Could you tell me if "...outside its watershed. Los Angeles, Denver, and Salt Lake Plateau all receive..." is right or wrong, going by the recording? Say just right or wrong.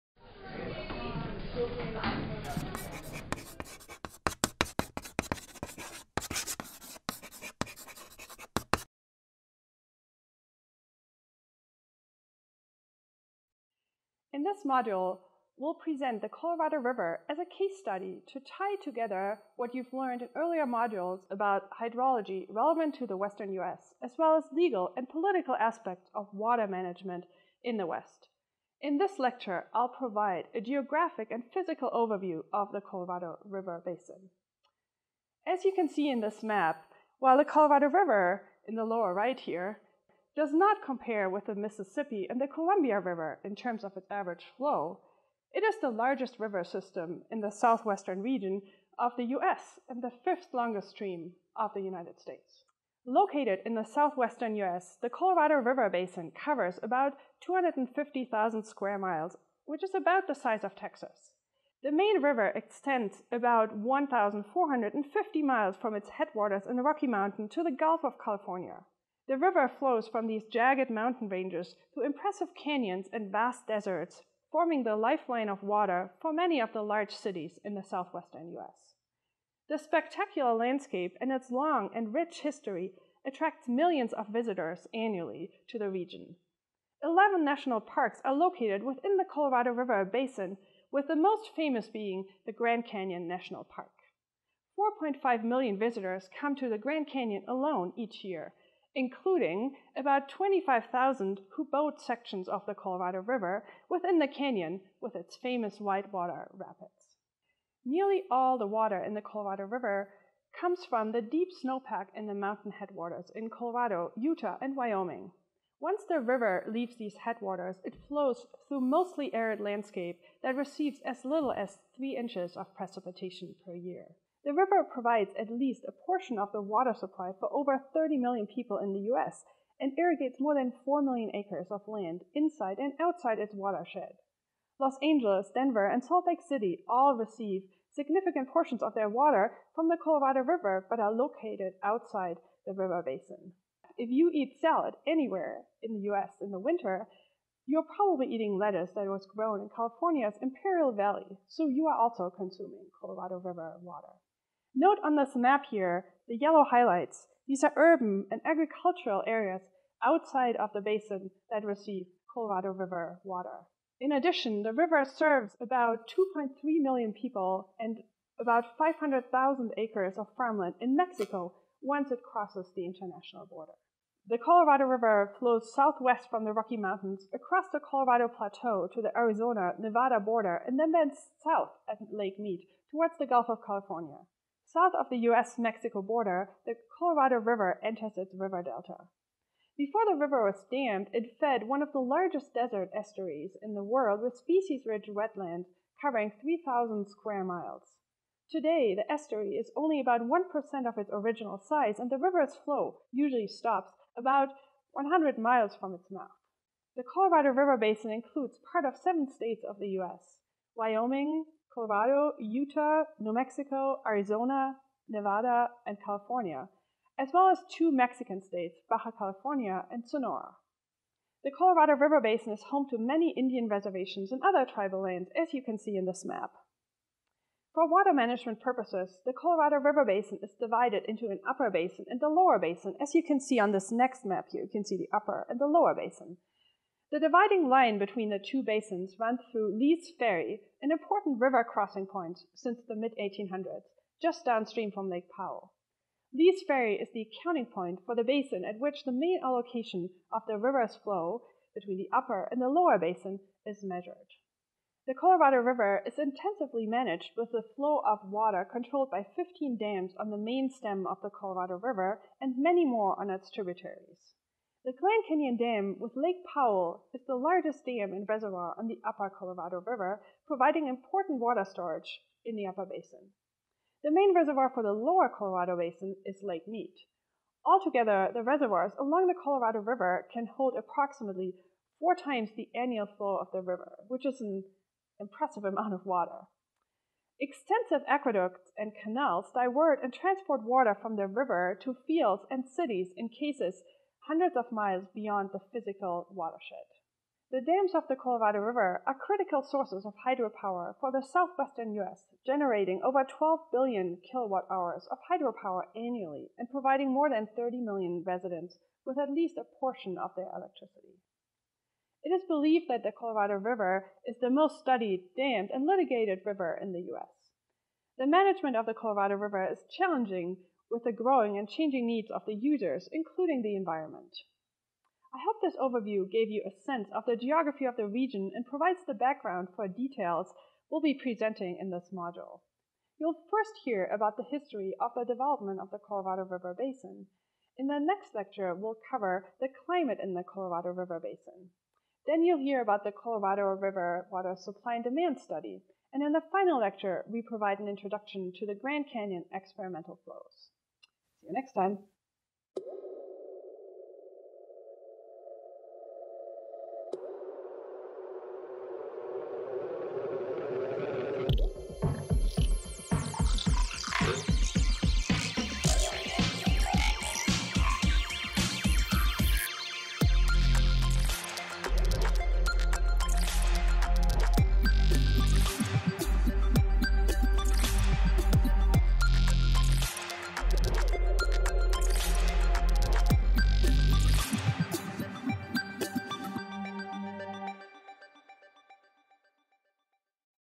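wrong.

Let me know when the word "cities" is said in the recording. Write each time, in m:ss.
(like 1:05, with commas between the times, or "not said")
1:17, 4:52.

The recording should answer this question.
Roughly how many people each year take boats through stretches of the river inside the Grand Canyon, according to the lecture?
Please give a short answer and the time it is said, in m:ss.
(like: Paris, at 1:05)
25,000, at 1:40.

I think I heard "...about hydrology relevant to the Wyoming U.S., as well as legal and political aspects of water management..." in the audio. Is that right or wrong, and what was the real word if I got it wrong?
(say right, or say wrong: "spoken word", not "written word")
wrong: "Western", not "Wyoming".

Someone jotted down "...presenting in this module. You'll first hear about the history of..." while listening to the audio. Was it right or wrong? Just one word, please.
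right.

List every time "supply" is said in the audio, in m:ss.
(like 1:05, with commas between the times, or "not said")
2:06, 5:44.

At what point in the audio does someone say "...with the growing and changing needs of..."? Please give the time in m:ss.
5:20.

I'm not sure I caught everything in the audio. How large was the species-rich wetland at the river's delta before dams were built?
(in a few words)
3,000 square miles.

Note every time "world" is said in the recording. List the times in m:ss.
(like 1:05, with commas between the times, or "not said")
3:13.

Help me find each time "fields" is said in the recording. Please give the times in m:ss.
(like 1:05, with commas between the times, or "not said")
4:52.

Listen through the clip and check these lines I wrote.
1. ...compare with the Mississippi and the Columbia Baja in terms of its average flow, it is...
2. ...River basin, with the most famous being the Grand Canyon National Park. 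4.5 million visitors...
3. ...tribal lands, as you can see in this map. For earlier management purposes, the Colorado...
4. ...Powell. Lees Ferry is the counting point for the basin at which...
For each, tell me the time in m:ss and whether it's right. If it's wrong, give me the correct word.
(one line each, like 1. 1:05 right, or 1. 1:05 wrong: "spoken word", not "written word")
1. 0:40 wrong: "River", not "Baja"
2. 1:29 right
3. 3:44 wrong: "water", not "earlier"
4. 4:05 right.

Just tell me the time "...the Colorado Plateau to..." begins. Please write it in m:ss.
2:57.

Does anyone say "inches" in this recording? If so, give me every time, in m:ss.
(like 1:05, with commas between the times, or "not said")
2:02.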